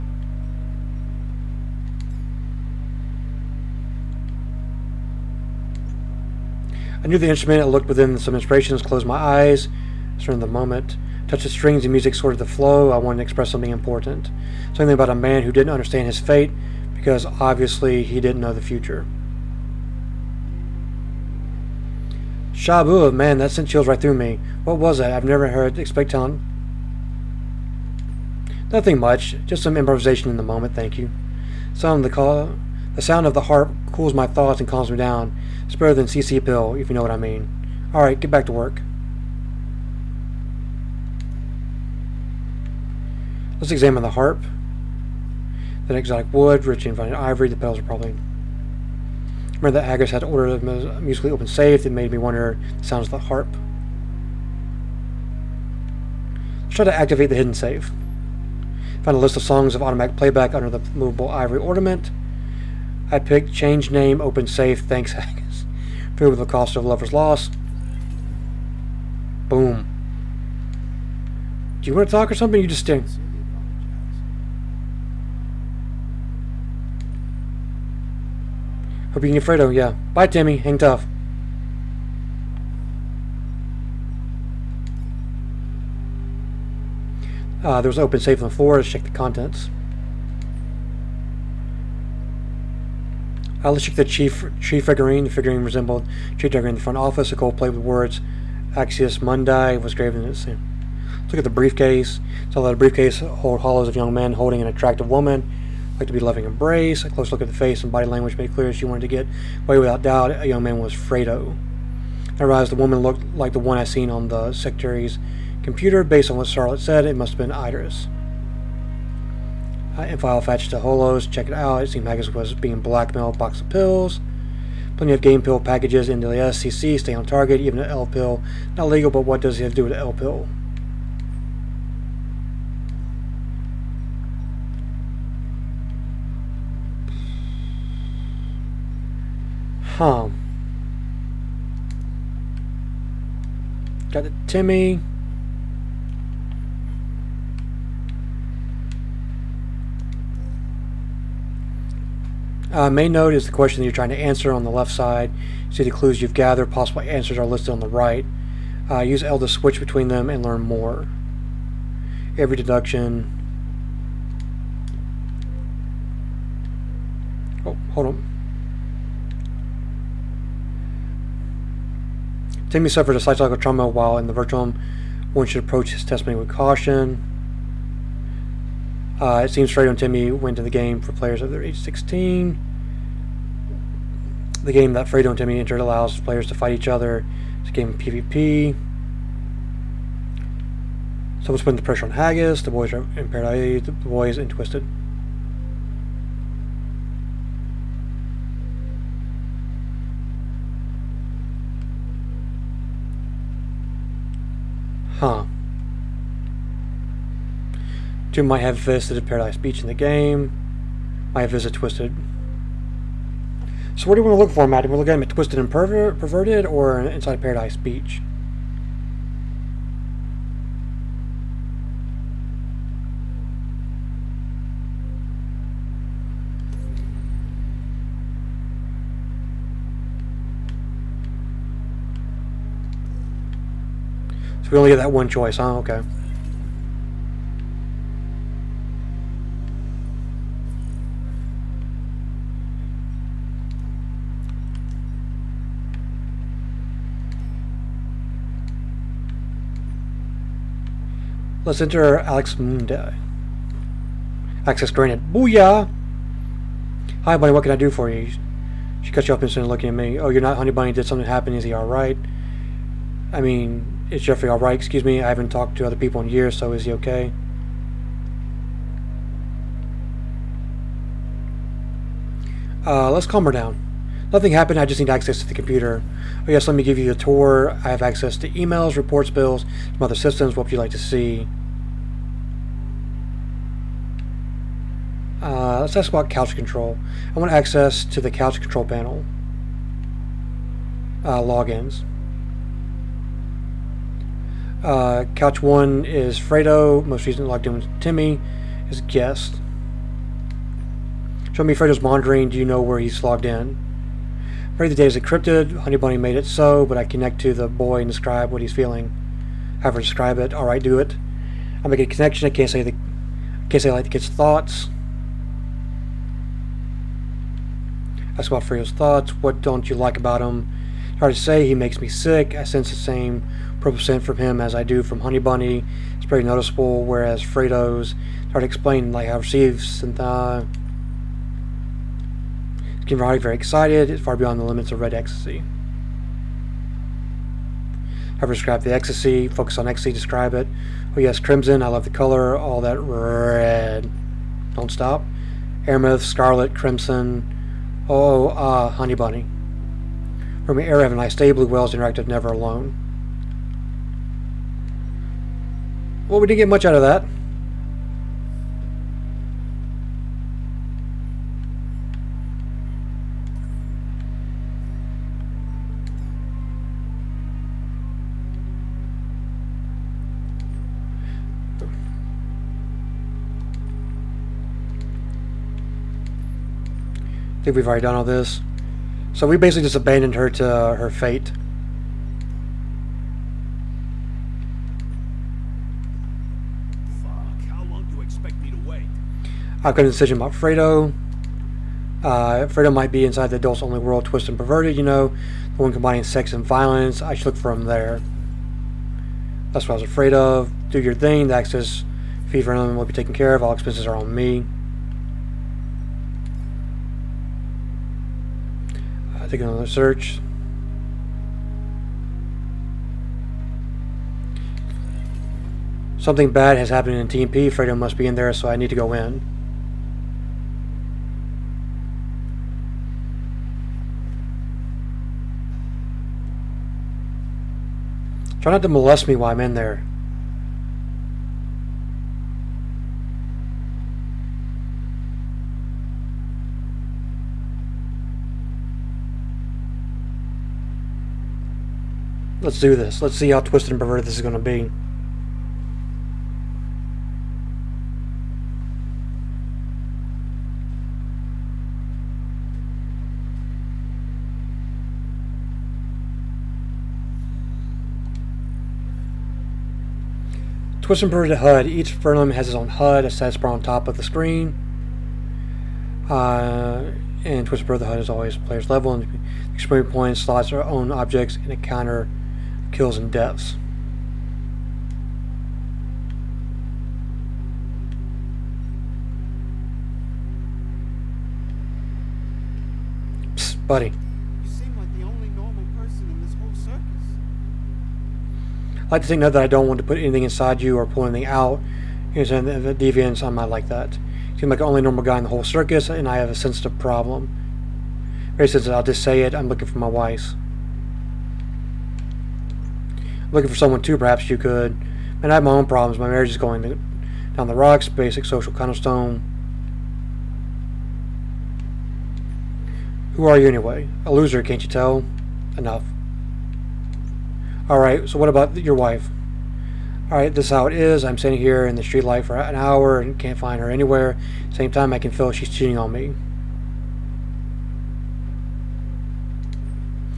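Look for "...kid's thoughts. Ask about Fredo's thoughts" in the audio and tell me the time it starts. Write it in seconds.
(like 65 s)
314 s.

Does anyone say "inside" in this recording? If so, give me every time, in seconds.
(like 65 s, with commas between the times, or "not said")
216 s, 393 s, 490 s.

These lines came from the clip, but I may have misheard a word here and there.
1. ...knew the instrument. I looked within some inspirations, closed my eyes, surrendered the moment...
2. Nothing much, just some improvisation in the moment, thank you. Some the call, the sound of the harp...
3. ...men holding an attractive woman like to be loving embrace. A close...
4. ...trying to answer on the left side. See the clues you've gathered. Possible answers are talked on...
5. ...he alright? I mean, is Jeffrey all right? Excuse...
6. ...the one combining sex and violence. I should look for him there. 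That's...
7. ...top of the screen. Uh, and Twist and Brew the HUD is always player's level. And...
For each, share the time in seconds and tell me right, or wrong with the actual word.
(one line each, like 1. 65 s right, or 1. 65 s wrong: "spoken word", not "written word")
1. 7 s right
2. 28 s right
3. 104 s right
4. 153 s wrong: "listed", not "talked"
5. 261 s right
6. 395 s right
7. 463 s right.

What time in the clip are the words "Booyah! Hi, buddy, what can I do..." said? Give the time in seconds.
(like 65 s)
255 s.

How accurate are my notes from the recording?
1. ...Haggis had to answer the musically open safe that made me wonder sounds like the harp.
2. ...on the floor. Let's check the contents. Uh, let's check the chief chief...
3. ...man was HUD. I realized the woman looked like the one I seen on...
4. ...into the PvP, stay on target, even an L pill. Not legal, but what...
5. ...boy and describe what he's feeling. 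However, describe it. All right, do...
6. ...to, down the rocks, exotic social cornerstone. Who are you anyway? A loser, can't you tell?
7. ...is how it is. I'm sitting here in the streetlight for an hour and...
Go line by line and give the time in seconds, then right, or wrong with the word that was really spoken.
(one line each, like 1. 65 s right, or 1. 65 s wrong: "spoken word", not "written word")
1. 49 s wrong: "order", not "answer"
2. 88 s right
3. 110 s wrong: "Fredo", not "HUD"
4. 126 s wrong: "SCC", not "PvP"
5. 307 s right
6. 506 s wrong: "basic", not "exotic"
7. 520 s right.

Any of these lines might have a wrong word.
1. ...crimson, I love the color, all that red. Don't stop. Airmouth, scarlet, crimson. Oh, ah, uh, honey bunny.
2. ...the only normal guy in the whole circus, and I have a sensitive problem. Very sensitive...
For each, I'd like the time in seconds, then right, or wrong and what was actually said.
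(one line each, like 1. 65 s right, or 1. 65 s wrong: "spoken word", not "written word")
1. 341 s right
2. 494 s right.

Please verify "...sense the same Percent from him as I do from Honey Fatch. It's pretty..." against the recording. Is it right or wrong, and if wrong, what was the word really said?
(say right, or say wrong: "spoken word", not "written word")
wrong: "Bunny", not "Fatch".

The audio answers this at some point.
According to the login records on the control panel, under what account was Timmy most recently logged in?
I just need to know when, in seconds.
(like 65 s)
297 s.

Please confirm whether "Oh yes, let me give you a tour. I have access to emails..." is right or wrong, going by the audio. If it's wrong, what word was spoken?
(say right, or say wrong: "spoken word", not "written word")
right.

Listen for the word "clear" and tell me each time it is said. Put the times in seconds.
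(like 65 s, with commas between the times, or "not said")
108 s.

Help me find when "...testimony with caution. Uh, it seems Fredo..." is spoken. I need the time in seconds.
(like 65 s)
176 s.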